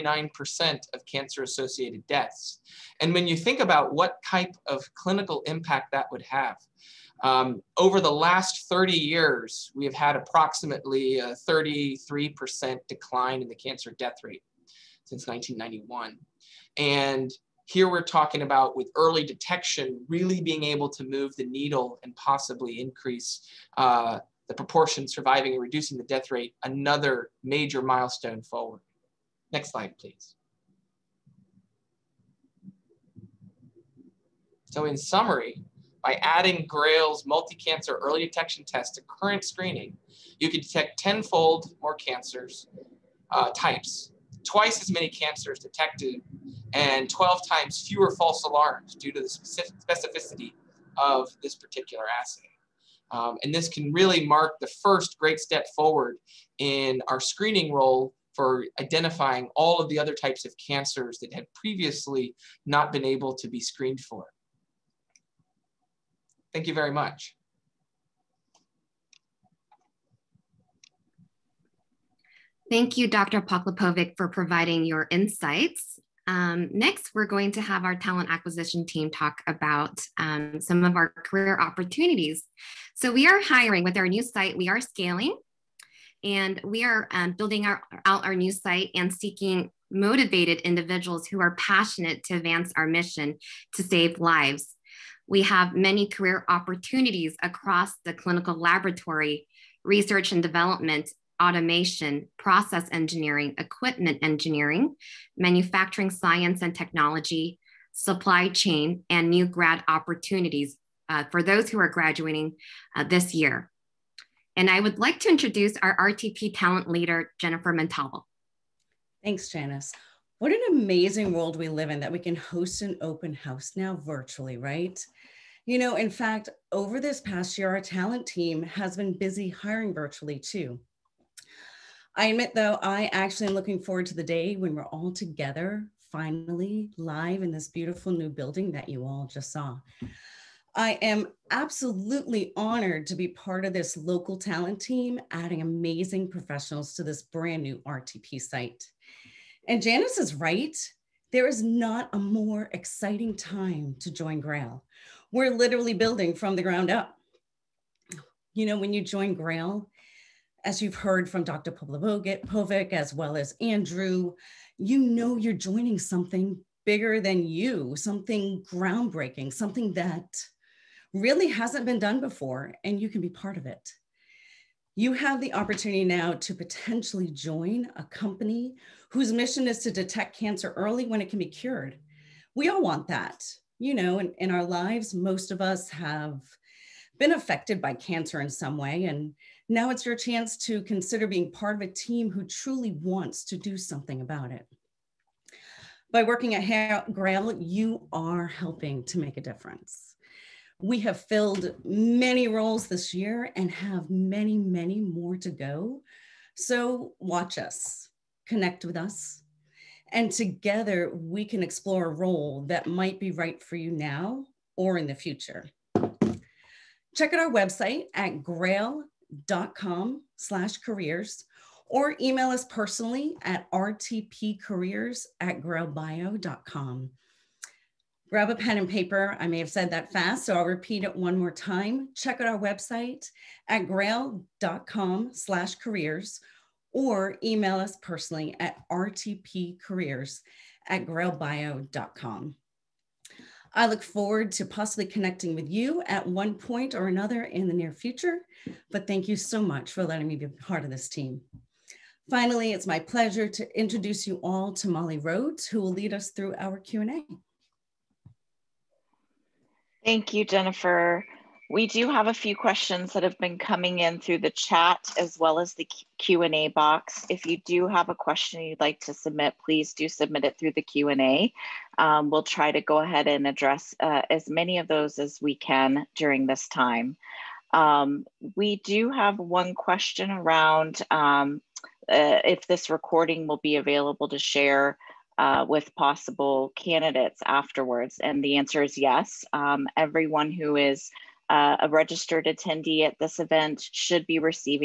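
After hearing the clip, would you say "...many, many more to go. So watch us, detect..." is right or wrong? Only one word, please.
wrong.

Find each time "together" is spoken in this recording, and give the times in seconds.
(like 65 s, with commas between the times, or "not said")
135 s, 210 s.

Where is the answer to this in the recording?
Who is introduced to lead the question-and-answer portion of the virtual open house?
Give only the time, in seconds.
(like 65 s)
254 s.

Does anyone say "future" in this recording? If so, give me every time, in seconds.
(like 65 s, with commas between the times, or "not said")
215 s, 247 s.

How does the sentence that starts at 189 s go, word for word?
And now it's your chance to consider being part of a team who truly wants to do something about it.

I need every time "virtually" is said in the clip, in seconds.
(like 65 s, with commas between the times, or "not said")
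124 s, 129 s.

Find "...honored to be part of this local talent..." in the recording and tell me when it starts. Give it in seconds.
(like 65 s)
142 s.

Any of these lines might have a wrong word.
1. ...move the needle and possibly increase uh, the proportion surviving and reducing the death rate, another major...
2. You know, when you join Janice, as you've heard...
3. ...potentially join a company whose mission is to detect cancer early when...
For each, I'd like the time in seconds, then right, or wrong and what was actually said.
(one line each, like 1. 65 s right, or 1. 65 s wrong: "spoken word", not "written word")
1. 21 s right
2. 158 s wrong: "Grail", not "Janice"
3. 176 s right.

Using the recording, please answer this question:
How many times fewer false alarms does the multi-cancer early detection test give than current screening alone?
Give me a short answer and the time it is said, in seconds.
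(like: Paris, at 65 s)
12, at 47 s.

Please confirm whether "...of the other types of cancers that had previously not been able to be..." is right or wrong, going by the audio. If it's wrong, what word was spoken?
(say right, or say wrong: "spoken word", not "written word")
right.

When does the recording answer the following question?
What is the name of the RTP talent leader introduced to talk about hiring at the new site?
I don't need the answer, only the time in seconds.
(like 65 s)
117 s.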